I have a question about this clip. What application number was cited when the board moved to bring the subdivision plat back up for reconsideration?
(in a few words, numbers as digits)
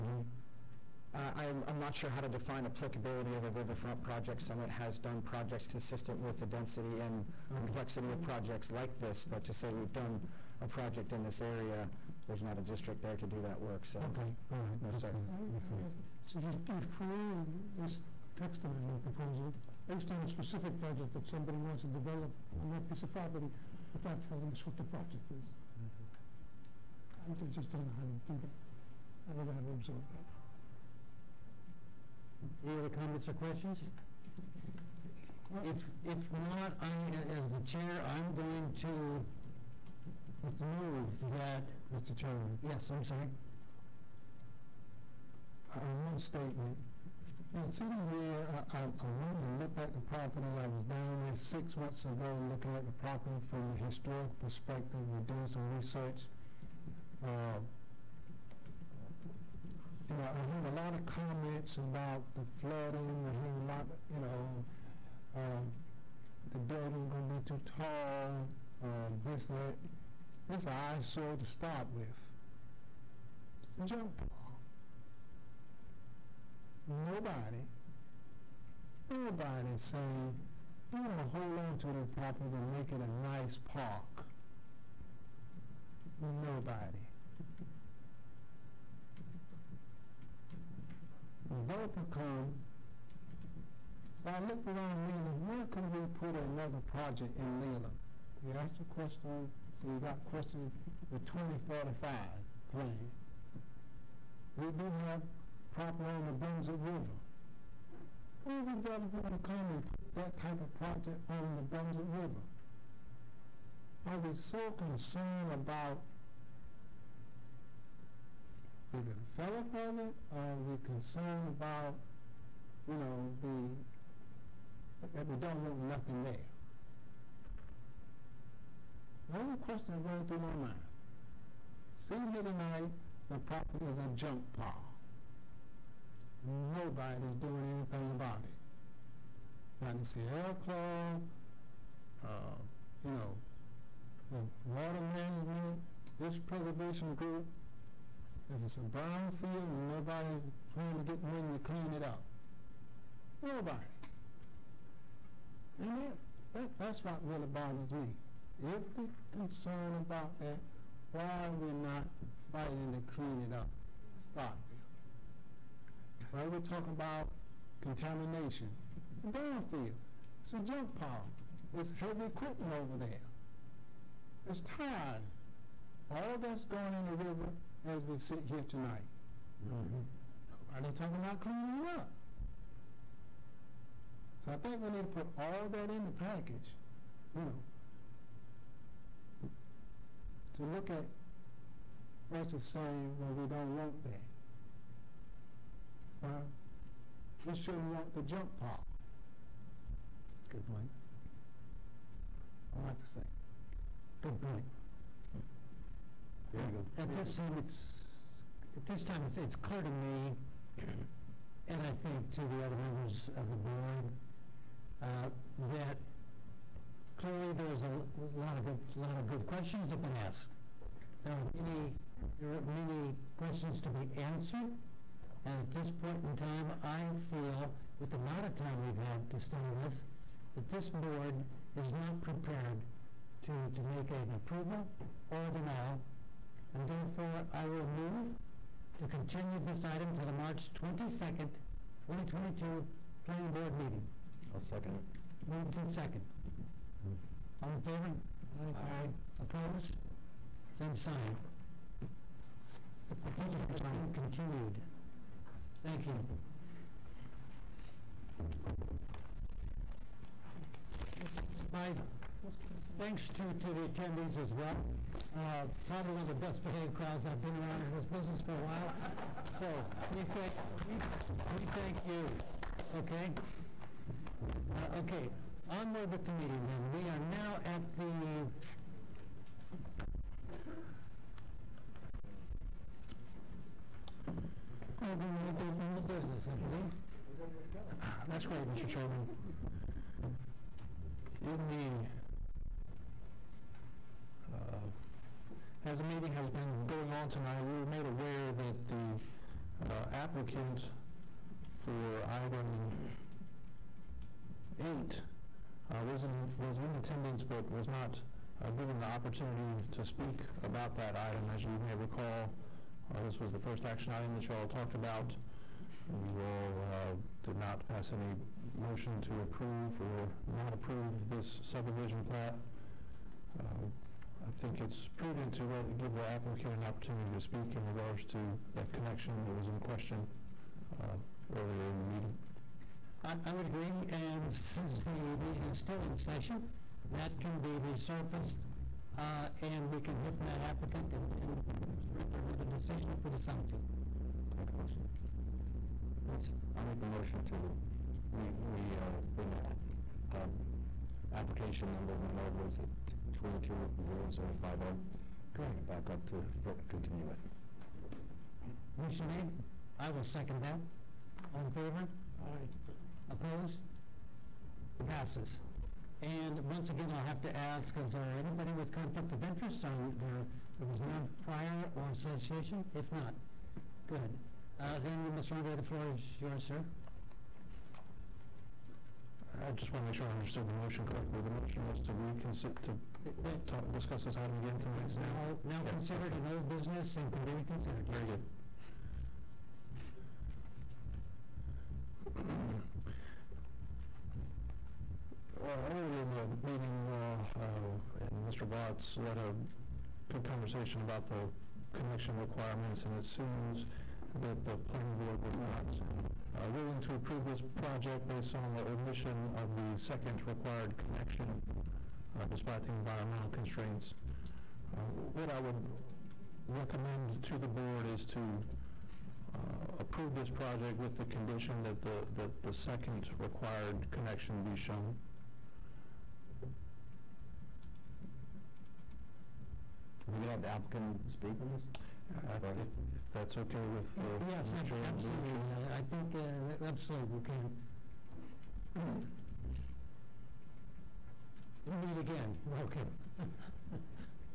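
220050.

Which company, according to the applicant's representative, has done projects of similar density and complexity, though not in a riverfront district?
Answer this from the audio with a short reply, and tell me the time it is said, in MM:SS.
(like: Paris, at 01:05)
Summit, at 00:04.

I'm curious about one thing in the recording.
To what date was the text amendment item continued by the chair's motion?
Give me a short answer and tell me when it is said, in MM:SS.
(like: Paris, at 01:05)
March 22nd, 2022, at 04:00.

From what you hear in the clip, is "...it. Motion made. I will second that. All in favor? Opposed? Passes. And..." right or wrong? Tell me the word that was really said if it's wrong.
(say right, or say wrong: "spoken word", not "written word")
right.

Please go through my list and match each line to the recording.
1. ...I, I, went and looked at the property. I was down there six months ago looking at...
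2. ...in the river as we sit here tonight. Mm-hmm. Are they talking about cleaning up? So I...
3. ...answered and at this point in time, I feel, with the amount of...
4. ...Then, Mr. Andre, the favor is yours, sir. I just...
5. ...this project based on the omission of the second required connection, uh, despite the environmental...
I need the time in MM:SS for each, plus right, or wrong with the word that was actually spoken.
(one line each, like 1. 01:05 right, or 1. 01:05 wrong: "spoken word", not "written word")
1. 00:48 right
2. 02:56 right
3. 03:44 right
4. 06:14 wrong: "floor", not "favor"
5. 06:47 right.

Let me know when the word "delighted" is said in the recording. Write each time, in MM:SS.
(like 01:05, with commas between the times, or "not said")
not said.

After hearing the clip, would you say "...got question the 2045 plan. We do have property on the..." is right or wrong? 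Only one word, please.
right.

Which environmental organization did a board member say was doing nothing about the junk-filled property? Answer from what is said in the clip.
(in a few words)
Sierra Club.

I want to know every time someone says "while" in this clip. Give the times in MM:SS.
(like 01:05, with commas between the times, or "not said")
04:28.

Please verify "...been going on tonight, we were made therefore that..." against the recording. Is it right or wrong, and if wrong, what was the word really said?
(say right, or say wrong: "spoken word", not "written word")
wrong: "aware", not "therefore".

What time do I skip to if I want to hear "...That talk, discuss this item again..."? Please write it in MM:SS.
06:23.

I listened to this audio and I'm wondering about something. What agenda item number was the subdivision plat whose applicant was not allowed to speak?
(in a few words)
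8.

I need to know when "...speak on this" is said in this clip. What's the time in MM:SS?
07:11.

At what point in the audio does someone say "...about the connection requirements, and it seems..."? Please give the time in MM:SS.
06:41.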